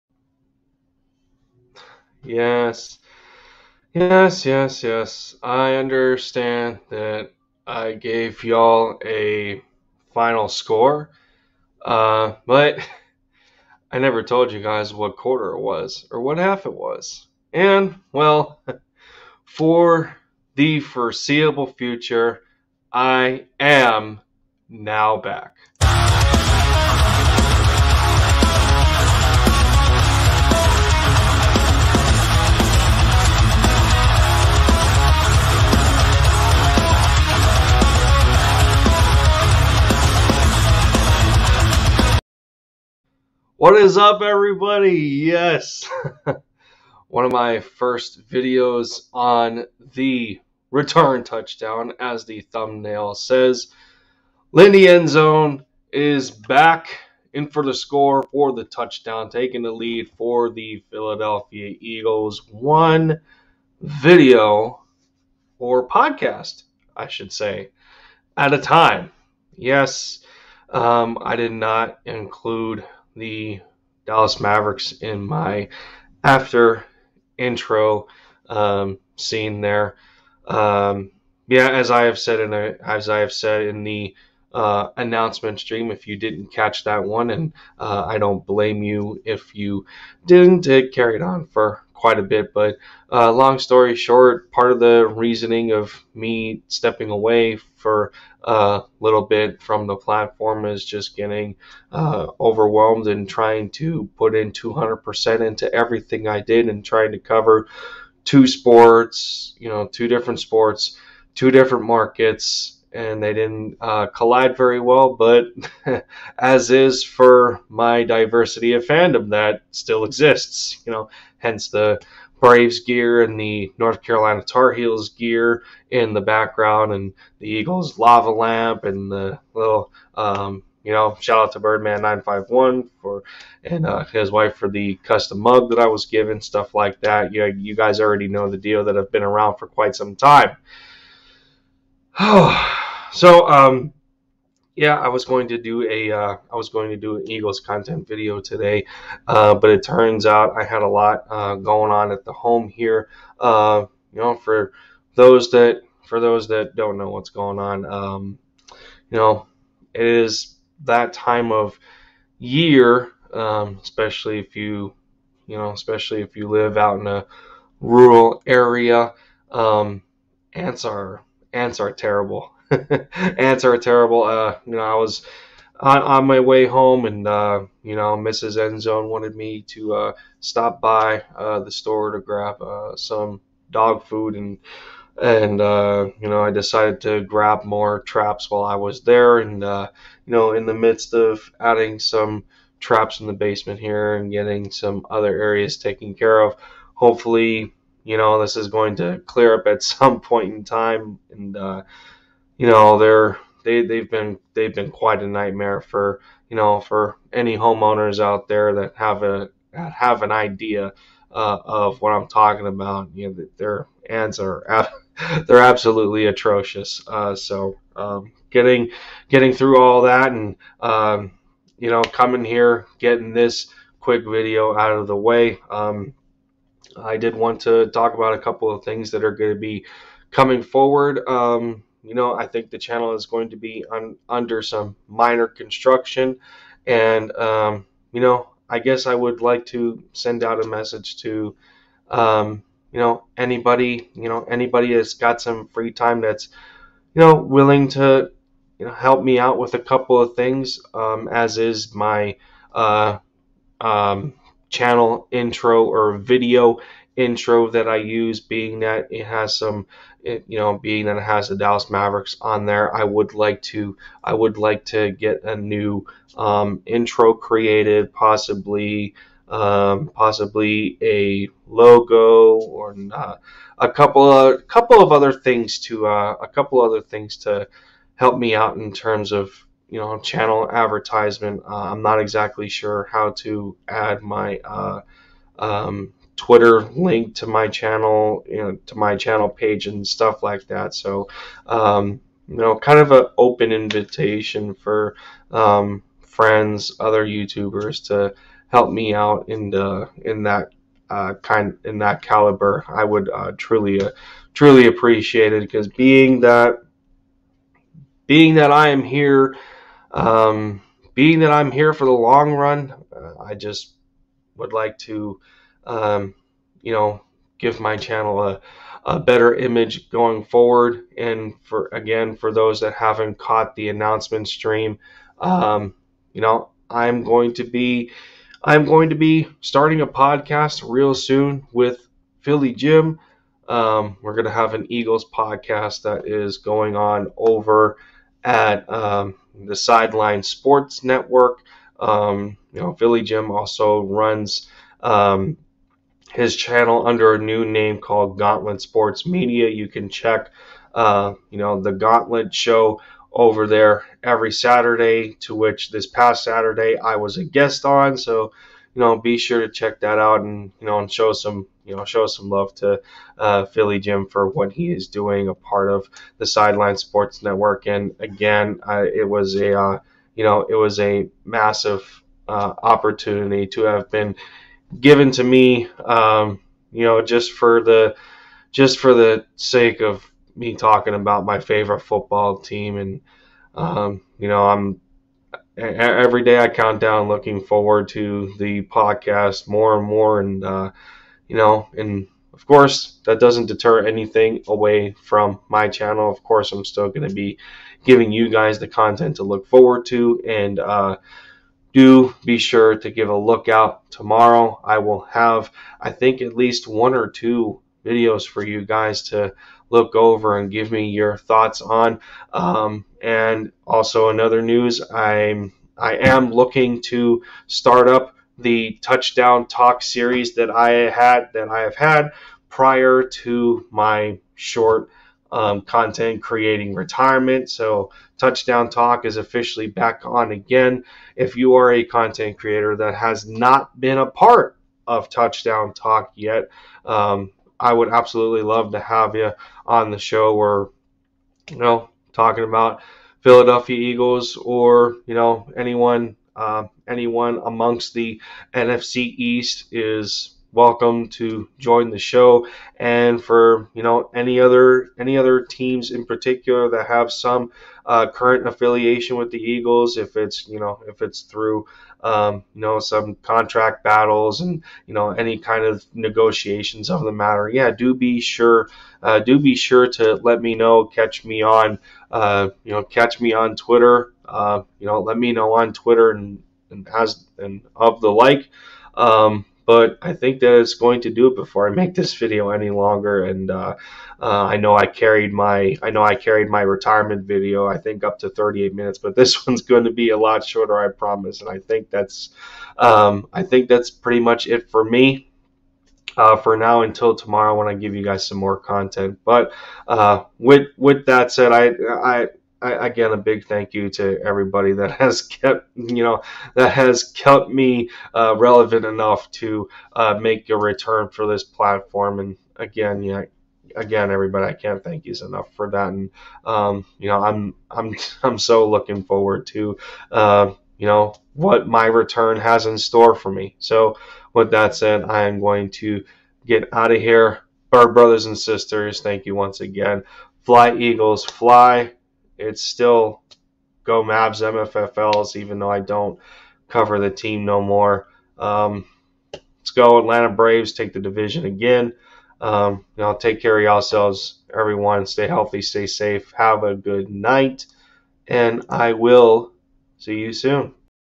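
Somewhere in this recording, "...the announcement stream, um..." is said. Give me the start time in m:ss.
5:23.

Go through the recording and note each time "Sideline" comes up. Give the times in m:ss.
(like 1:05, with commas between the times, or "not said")
5:39, 6:06.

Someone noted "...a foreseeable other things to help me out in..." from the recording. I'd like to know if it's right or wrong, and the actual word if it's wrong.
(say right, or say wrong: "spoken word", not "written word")
wrong: "couple", not "foreseeable".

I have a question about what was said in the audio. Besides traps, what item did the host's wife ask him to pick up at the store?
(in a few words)
Dog food.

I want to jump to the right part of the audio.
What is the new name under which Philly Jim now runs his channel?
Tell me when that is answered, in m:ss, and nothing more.
5:48.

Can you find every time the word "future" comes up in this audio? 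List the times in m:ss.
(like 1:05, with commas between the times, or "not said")
0:21.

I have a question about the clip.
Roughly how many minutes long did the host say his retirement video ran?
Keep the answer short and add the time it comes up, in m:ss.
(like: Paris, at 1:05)
38, at 8:08.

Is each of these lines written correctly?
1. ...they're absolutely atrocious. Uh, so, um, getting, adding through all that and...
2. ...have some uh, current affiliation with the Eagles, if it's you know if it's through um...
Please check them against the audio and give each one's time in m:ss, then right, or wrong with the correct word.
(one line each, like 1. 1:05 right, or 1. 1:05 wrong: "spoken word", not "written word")
1. 3:35 wrong: "getting", not "adding"
2. 7:37 right.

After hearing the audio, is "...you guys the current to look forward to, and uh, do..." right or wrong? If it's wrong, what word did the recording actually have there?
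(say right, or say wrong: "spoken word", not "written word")
wrong: "content", not "current".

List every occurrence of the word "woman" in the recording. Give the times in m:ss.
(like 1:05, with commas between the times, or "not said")
not said.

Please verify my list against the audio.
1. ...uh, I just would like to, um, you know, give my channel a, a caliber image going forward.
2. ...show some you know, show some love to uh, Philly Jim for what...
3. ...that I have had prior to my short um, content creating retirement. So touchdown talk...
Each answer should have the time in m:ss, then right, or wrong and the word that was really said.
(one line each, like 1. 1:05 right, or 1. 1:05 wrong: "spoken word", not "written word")
1. 5:13 wrong: "better", not "caliber"
2. 6:01 right
3. 7:01 right.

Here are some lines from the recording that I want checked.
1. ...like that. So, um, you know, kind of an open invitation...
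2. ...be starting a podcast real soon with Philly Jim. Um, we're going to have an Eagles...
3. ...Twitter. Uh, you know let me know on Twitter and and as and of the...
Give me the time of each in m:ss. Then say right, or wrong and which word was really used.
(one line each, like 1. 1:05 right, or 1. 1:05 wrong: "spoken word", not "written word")
1. 4:50 right
2. 5:29 right
3. 7:53 right.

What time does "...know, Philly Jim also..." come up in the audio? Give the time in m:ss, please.
5:42.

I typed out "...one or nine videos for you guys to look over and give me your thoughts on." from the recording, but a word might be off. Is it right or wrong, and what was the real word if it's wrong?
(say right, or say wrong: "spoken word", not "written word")
wrong: "two", not "nine".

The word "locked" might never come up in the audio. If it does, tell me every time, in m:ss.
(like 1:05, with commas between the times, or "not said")
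not said.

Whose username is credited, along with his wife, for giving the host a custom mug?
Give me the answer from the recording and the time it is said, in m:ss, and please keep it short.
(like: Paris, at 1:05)
Birdman951, at 2:11.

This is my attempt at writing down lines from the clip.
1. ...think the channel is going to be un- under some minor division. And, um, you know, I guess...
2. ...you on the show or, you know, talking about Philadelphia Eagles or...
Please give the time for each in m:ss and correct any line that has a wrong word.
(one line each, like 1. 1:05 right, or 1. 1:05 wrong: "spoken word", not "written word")
1. 3:52 wrong: "construction", not "division"
2. 7:19 right.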